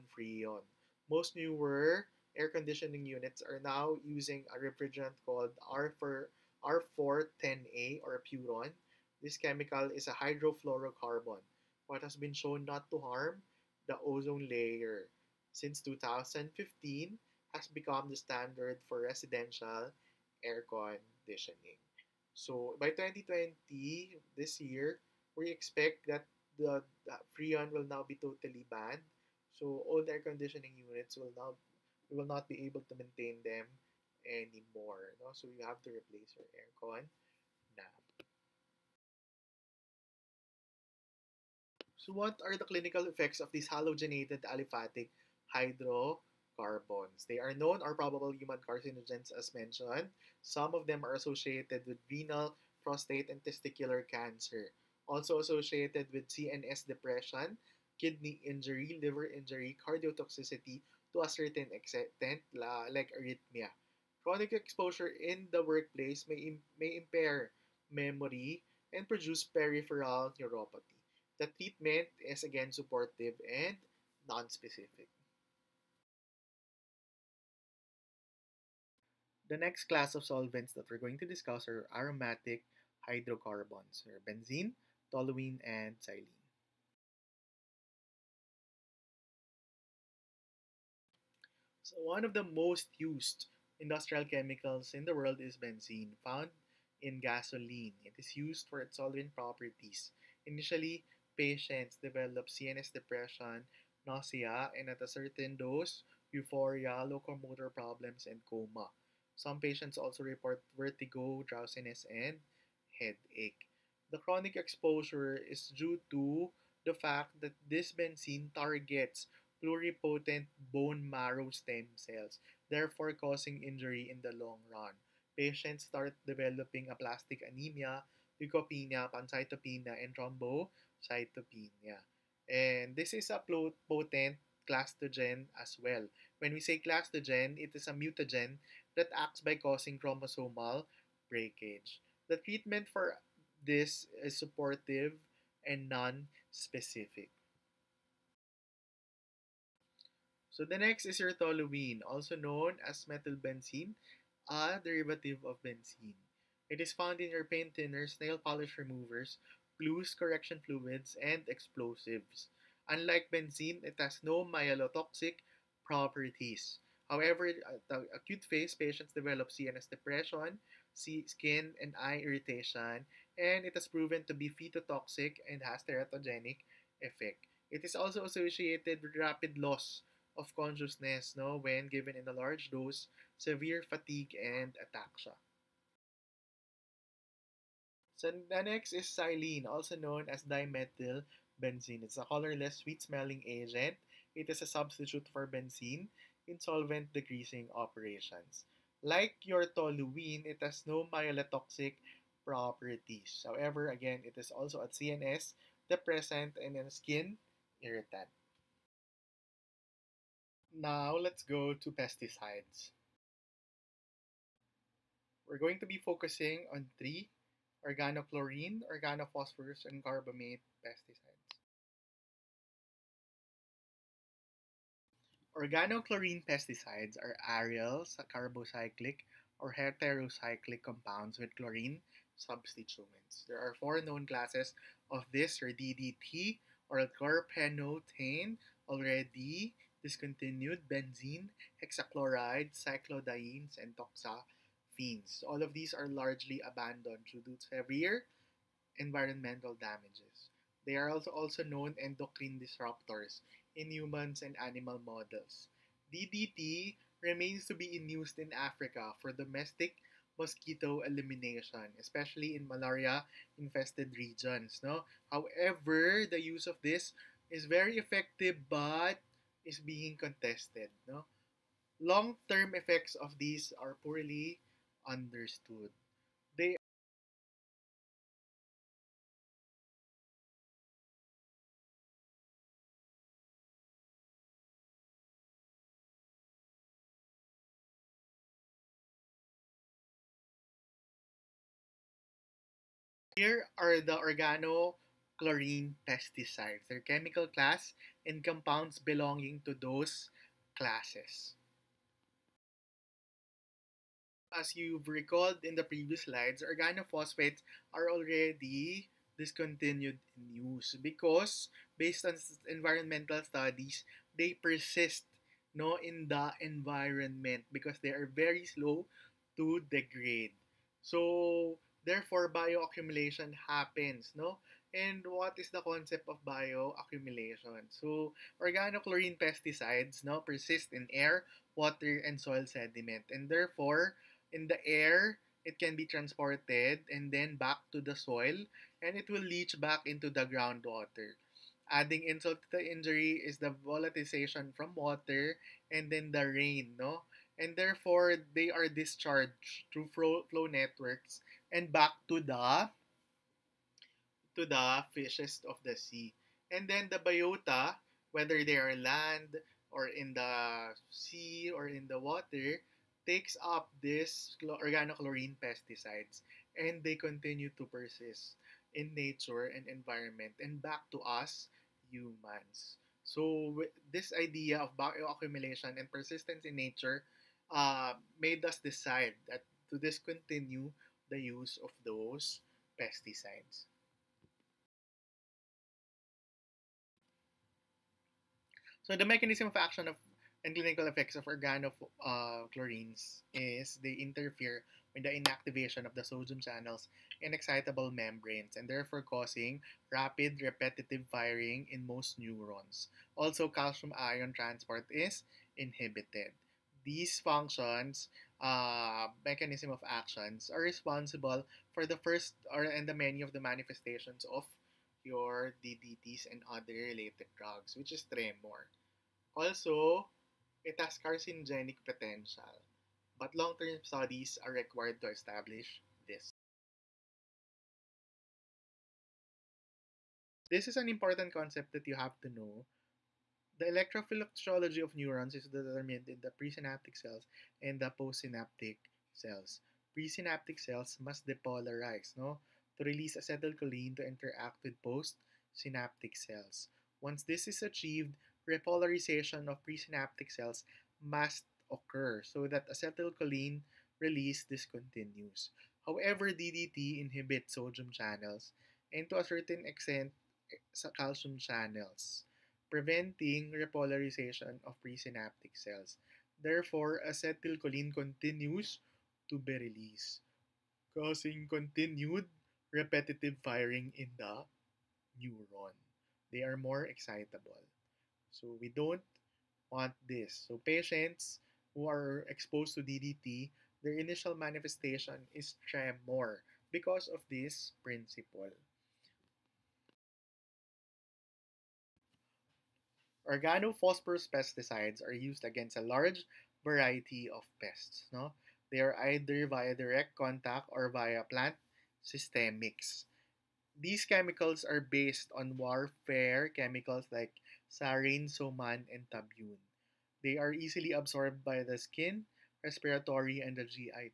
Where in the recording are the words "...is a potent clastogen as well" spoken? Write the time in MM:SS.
02:13.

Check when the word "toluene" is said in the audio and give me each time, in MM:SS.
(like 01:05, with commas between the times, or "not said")
01:25, 03:19.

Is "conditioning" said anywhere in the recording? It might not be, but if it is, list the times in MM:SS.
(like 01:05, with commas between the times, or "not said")
00:02, 00:20, 00:30.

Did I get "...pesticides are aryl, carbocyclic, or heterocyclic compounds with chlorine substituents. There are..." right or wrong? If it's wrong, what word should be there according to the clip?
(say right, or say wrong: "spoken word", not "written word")
right.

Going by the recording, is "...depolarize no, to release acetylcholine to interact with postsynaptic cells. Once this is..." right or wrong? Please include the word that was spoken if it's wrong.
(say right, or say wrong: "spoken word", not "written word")
right.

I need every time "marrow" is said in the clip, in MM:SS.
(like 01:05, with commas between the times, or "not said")
02:01.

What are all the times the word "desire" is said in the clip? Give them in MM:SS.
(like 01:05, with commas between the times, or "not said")
not said.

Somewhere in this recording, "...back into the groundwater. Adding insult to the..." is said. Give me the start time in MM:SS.
05:39.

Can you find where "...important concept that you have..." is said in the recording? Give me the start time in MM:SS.
07:11.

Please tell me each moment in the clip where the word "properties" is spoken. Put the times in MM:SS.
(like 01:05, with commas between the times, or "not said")
01:39, 02:45, 03:22.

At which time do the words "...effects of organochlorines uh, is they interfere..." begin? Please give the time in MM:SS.
06:31.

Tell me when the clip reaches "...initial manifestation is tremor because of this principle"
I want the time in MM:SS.
08:04.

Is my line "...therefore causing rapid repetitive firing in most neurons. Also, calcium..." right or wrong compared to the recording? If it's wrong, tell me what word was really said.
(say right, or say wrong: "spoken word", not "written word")
right.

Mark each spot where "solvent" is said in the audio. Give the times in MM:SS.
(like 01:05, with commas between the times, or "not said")
01:20, 01:38, 03:16.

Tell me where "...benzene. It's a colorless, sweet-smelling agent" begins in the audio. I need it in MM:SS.
03:11.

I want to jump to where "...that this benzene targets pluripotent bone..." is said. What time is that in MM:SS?
01:57.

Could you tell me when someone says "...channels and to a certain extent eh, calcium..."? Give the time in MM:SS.
07:38.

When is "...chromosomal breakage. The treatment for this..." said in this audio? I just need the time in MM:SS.
02:19.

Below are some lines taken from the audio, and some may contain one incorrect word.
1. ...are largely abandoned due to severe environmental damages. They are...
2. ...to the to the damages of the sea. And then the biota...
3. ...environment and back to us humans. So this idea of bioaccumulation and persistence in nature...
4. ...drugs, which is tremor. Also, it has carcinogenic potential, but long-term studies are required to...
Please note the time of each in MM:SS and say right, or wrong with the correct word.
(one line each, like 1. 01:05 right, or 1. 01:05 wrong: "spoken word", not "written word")
1. 04:05 right
2. 05:52 wrong: "fishes", not "damages"
3. 06:09 right
4. 06:57 right.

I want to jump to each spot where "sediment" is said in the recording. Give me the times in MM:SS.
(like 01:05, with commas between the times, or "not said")
05:32.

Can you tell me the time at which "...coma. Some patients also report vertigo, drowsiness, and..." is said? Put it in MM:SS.
01:48.